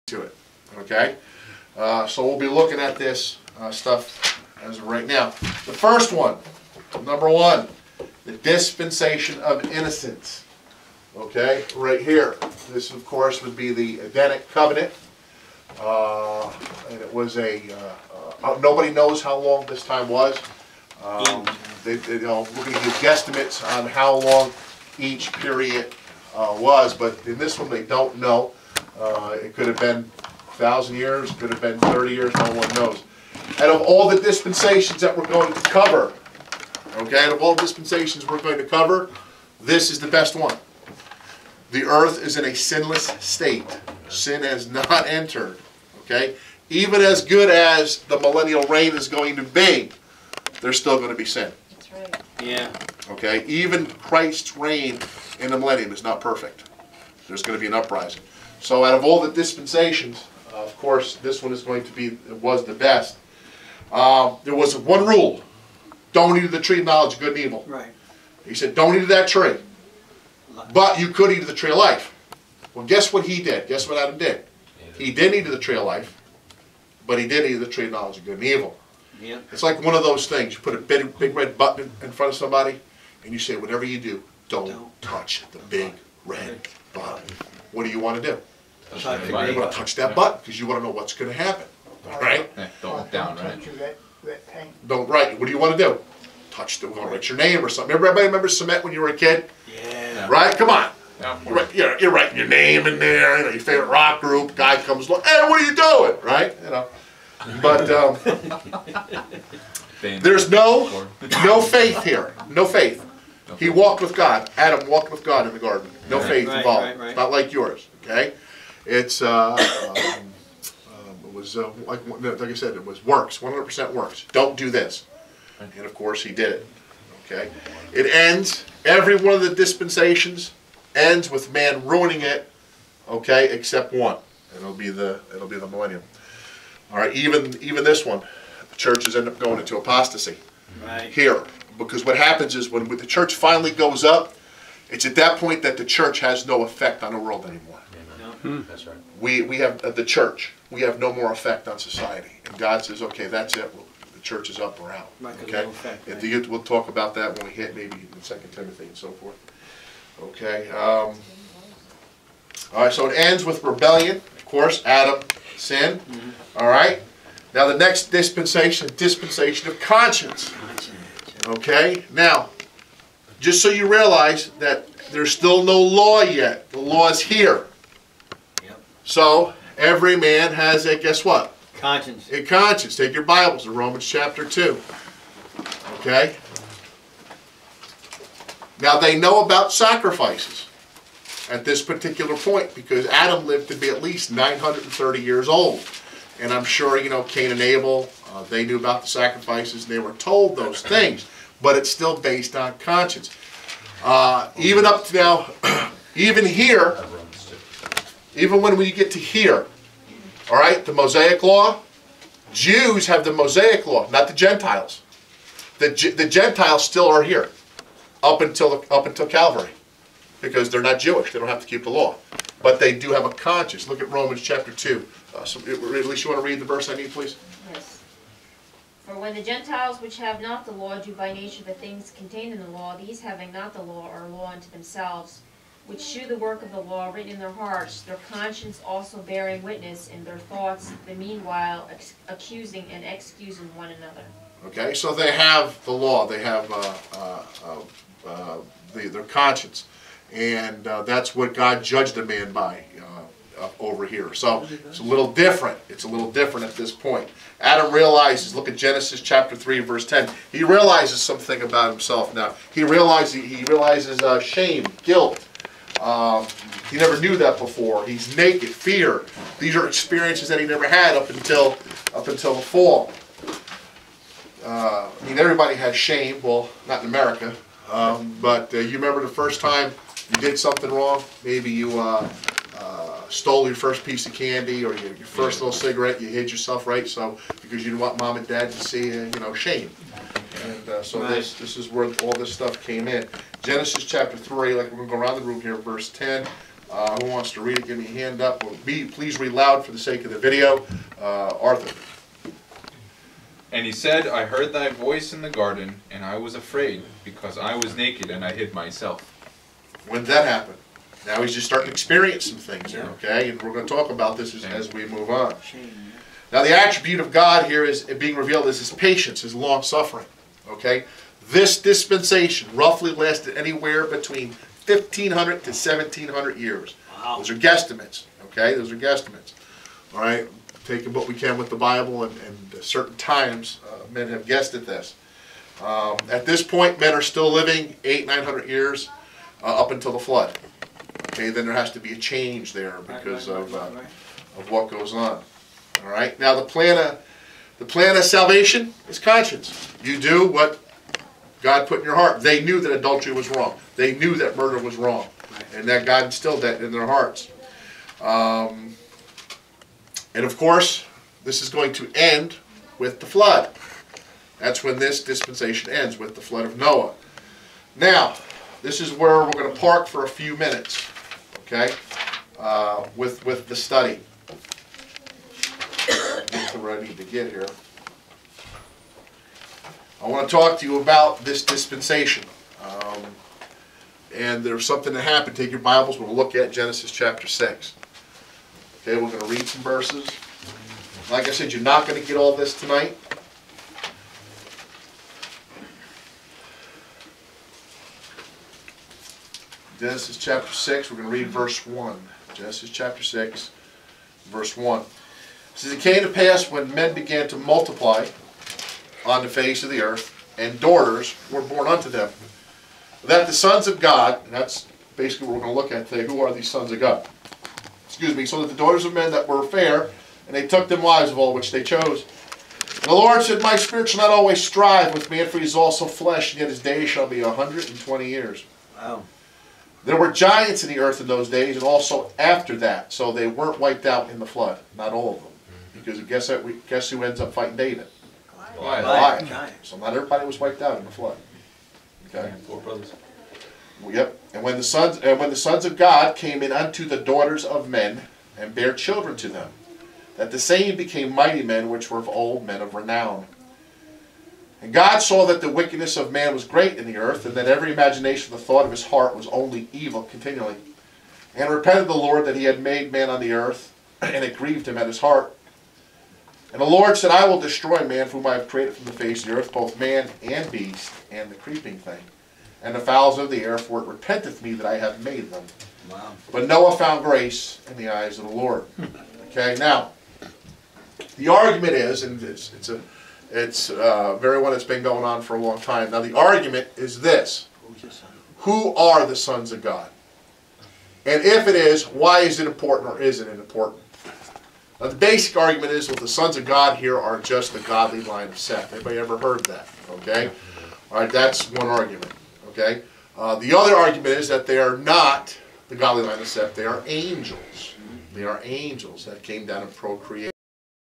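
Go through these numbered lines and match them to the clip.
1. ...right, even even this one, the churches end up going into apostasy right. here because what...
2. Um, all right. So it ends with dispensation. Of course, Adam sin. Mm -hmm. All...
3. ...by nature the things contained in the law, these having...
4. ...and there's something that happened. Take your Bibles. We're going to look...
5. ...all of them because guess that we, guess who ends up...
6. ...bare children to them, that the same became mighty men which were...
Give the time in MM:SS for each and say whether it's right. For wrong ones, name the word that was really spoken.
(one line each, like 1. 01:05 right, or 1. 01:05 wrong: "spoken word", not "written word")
1. 02:16 right
2. 02:40 wrong: "rebellion", not "dispensation"
3. 03:51 right
4. 06:24 right
5. 07:15 right
6. 07:28 right.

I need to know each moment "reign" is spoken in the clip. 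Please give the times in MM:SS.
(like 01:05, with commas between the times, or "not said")
00:48, 00:54.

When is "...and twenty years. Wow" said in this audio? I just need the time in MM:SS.
07:07.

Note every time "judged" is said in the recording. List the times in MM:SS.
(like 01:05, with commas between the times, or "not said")
04:11.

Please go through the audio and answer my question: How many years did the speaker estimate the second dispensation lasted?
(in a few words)
1500 to 1700 years.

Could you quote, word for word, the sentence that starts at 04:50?
And uh, so this, this is where all this stuff came in.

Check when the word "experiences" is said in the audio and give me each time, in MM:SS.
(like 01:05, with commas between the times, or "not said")
04:29, 05:11.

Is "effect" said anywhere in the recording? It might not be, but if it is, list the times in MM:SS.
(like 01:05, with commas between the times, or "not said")
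02:26, 02:31, 02:35.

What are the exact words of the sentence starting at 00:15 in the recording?
Uh, and it was a, uh, uh, uh, nobody knows how long this time was.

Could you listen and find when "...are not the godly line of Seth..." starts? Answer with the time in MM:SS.
08:24.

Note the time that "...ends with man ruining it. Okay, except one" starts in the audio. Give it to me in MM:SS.
02:10.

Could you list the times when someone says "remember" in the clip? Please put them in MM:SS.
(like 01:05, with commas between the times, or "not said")
01:38, 04:38.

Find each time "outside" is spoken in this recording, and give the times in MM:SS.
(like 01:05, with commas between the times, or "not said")
not said.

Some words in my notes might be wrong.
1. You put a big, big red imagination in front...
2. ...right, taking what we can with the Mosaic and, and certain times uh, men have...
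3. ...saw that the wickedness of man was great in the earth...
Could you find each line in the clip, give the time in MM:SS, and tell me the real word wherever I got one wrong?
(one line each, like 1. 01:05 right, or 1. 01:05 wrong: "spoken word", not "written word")
1. 01:20 wrong: "button", not "imagination"
2. 05:30 wrong: "Bible", not "Mosaic"
3. 07:35 right.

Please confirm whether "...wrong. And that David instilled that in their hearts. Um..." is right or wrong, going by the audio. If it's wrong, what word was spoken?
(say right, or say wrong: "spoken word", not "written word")
wrong: "God", not "David".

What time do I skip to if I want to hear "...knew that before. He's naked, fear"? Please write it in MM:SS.
04:27.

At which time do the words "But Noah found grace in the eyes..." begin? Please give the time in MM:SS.
07:56.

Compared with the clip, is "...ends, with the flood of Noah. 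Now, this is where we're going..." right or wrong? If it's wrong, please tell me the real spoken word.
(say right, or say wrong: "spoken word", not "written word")
right.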